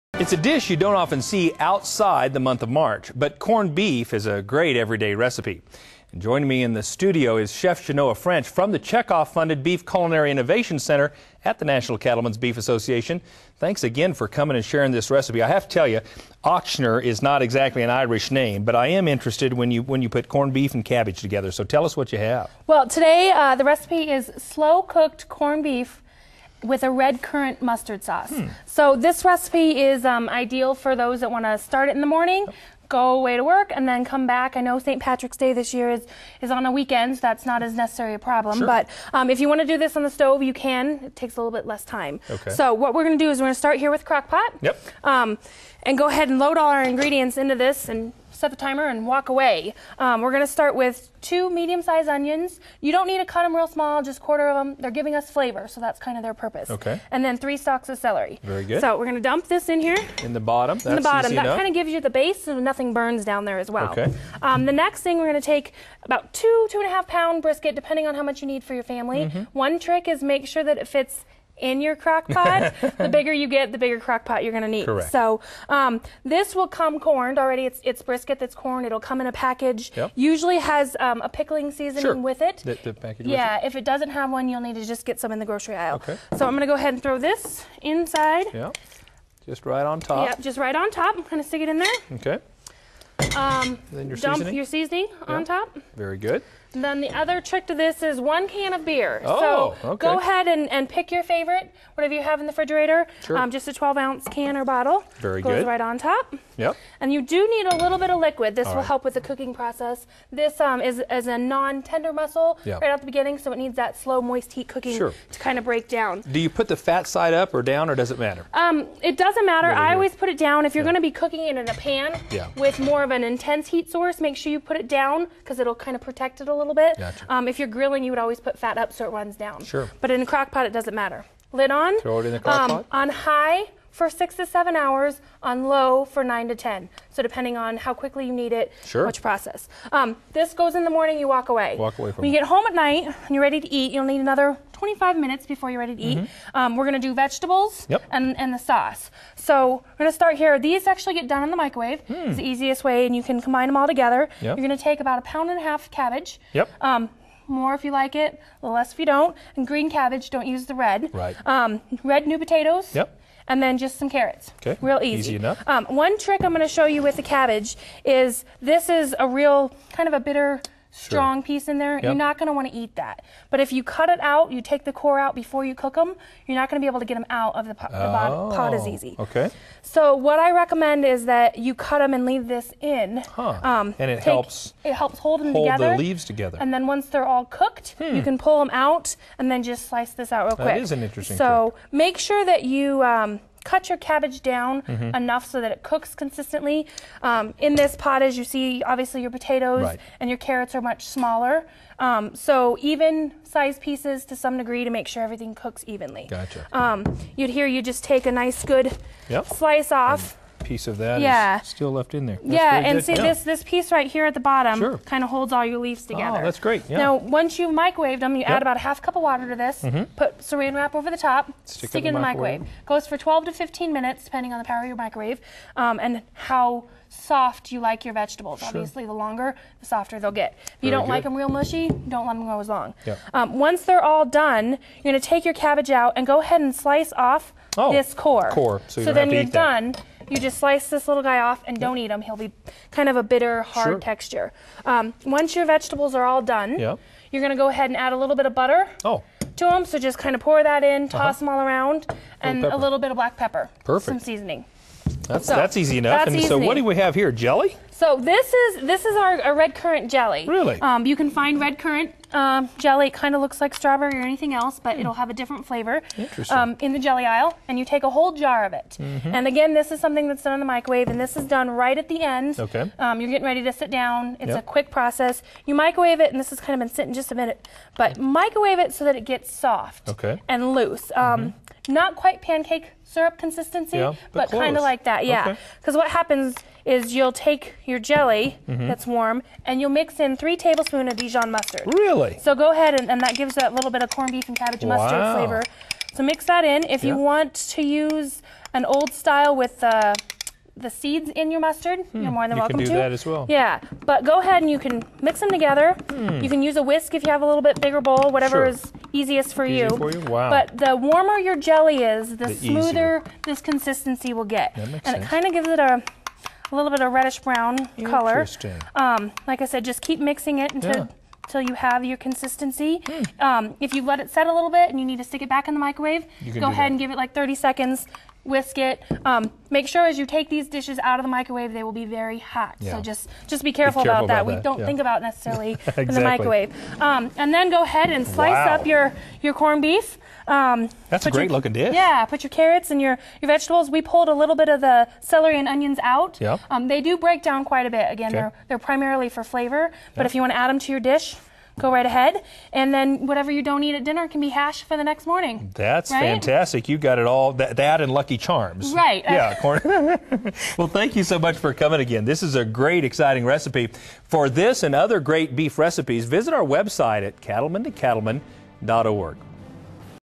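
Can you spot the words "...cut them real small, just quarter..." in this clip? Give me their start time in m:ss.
0:53.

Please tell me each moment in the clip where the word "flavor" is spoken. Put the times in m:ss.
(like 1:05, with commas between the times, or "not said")
0:55, 4:25, 4:55, 5:49.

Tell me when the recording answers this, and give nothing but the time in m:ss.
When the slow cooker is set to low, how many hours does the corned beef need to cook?
2:15.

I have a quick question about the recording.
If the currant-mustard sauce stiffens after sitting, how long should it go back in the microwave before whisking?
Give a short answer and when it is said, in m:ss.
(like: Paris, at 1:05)
30 seconds, at 5:27.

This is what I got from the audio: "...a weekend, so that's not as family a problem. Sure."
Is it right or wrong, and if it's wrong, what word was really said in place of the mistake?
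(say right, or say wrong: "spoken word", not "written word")
wrong: "necessarily", not "family".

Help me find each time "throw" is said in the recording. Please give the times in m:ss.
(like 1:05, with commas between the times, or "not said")
1:27, 2:11.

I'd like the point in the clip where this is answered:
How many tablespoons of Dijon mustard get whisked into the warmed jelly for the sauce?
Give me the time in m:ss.
4:50.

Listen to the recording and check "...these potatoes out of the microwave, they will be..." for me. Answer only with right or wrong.
wrong.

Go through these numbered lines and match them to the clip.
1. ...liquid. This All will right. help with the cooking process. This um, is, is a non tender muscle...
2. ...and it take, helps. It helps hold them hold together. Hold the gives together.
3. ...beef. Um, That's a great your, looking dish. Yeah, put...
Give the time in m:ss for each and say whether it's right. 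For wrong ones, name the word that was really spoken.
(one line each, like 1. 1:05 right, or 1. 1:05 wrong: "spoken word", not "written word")
1. 1:48 right
2. 3:03 wrong: "leaves", not "gives"
3. 5:39 right.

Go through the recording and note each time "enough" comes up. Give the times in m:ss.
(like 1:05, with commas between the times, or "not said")
2:45, 3:15, 4:15.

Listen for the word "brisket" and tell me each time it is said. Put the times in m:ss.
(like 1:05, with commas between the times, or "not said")
1:07, 1:18.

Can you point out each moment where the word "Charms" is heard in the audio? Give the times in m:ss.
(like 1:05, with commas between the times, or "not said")
5:58.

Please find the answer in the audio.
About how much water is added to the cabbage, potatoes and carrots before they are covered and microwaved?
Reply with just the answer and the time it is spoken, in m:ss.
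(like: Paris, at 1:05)
half cup, at 3:38.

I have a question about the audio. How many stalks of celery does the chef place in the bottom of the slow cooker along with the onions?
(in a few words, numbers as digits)
3.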